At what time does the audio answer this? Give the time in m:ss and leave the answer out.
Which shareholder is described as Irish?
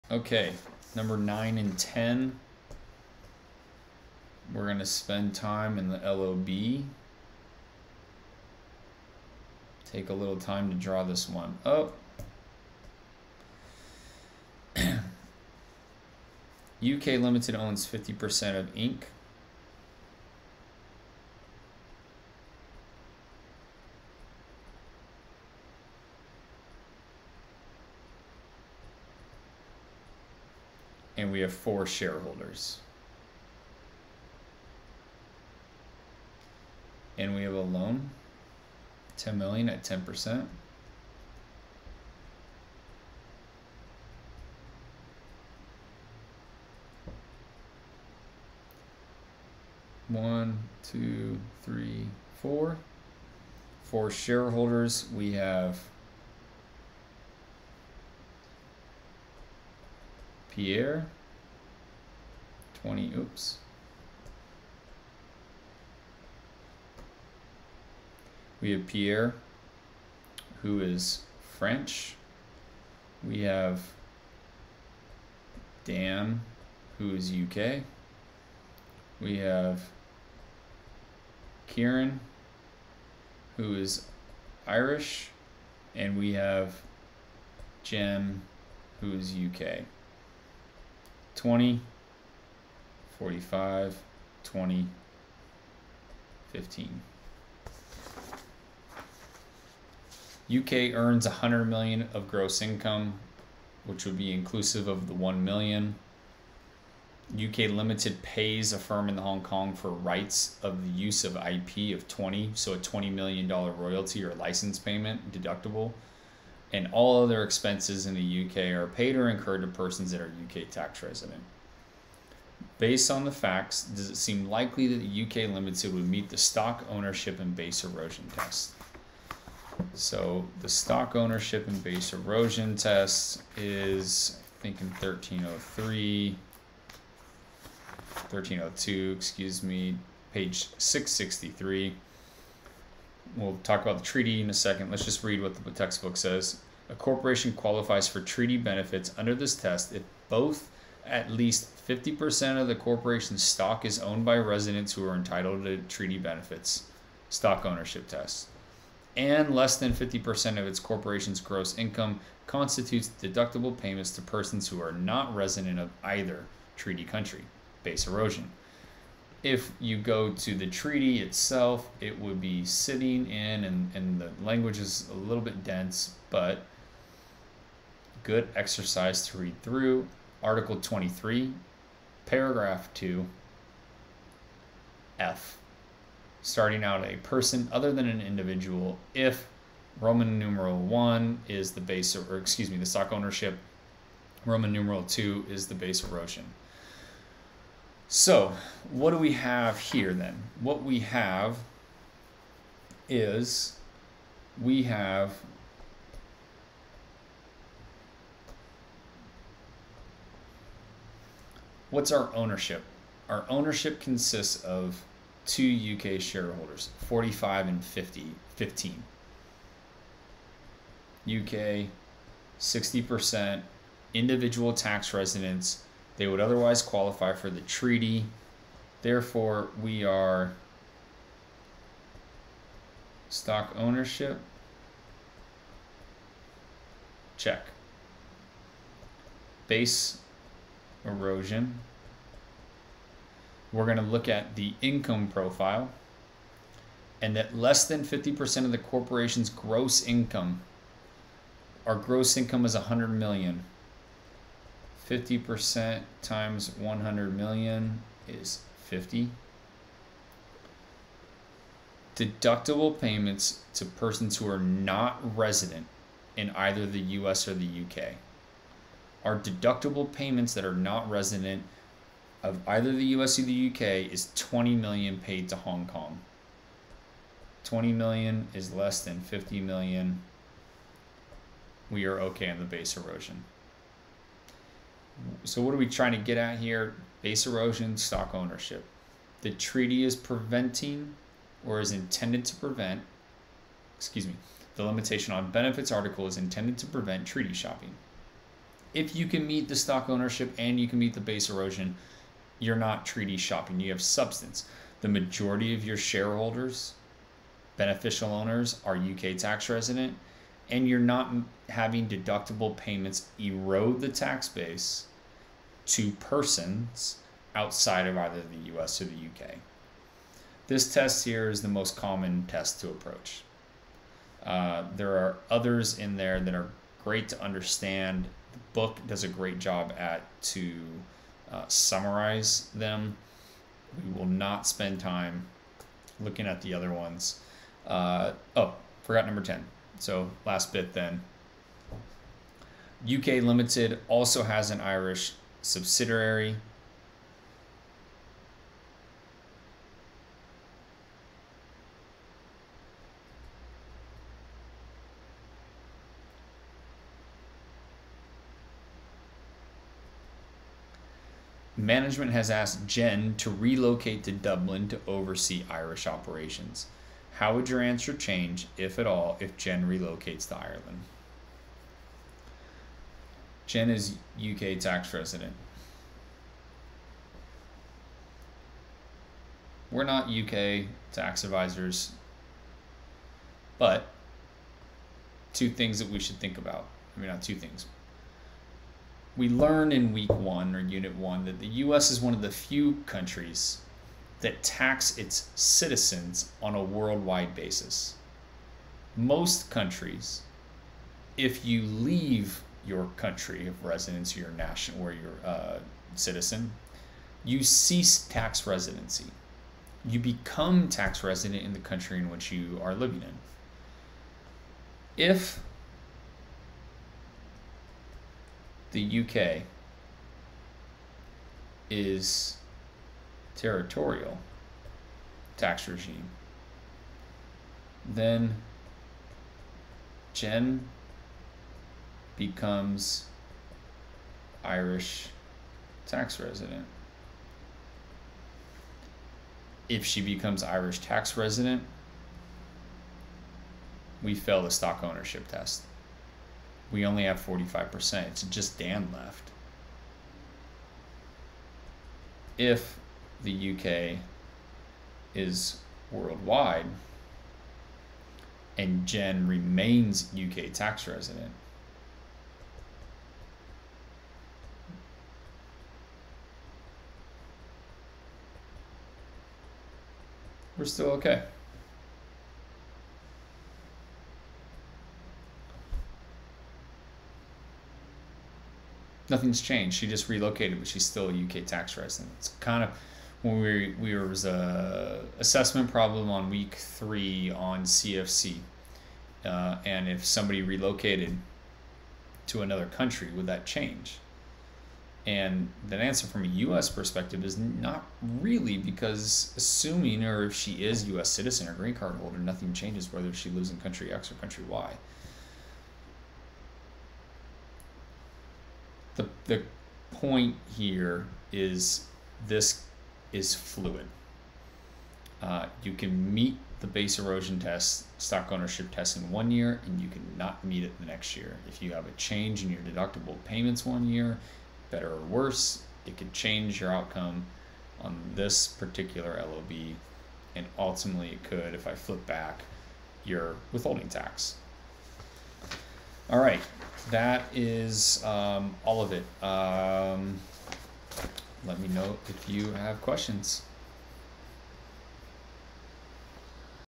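1:21.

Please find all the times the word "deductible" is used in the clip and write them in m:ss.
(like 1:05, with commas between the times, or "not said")
1:55, 2:43, 4:22, 4:29, 5:12, 8:42.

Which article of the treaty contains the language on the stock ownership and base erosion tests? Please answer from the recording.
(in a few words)
Article 23.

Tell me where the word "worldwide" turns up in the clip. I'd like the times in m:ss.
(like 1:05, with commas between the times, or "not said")
6:36, 7:36.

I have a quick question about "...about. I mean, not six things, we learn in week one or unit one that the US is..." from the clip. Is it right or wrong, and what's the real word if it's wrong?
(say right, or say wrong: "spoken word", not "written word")
wrong: "two", not "six".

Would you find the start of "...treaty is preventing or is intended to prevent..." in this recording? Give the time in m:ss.
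4:49.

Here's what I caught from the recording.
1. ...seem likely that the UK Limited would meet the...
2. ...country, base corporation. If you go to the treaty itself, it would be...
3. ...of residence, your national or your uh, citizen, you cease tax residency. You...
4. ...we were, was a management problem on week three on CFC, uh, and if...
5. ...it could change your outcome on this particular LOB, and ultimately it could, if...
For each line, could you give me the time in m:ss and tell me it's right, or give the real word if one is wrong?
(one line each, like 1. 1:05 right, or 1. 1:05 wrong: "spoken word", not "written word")
1. 2:04 right
2. 2:47 wrong: "erosion", not "corporation"
3. 6:43 right
4. 8:03 wrong: "assessment", not "management"
5. 8:46 right.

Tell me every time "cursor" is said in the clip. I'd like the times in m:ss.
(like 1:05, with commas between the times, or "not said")
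not said.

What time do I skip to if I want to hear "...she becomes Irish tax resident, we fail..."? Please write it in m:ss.
7:20.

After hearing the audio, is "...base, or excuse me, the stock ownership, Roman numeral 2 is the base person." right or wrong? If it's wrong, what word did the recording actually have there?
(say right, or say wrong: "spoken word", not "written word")
wrong: "erosion", not "person".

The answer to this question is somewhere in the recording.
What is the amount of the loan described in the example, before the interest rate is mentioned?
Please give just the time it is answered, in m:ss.
0:39.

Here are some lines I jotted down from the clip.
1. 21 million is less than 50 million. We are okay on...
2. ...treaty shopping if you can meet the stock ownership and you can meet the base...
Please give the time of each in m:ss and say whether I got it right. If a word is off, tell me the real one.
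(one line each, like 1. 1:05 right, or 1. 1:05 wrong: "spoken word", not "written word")
1. 4:37 wrong: "20", not "21"
2. 4:57 right.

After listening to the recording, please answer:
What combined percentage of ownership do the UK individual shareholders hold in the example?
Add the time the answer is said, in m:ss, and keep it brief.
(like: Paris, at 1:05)
60%, at 3:42.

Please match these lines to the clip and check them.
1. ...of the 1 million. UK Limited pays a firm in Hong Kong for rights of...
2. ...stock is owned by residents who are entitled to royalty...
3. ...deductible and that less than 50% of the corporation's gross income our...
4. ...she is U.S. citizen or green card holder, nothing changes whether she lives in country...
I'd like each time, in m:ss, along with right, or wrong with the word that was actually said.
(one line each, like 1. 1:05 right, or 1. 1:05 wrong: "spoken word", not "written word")
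1. 1:44 right
2. 2:33 wrong: "treaty", not "royalty"
3. 4:05 wrong: "profile", not "deductible"
4. 8:20 right.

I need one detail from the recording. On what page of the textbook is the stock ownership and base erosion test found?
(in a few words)
663.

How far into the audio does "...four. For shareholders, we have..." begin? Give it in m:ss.
0:52.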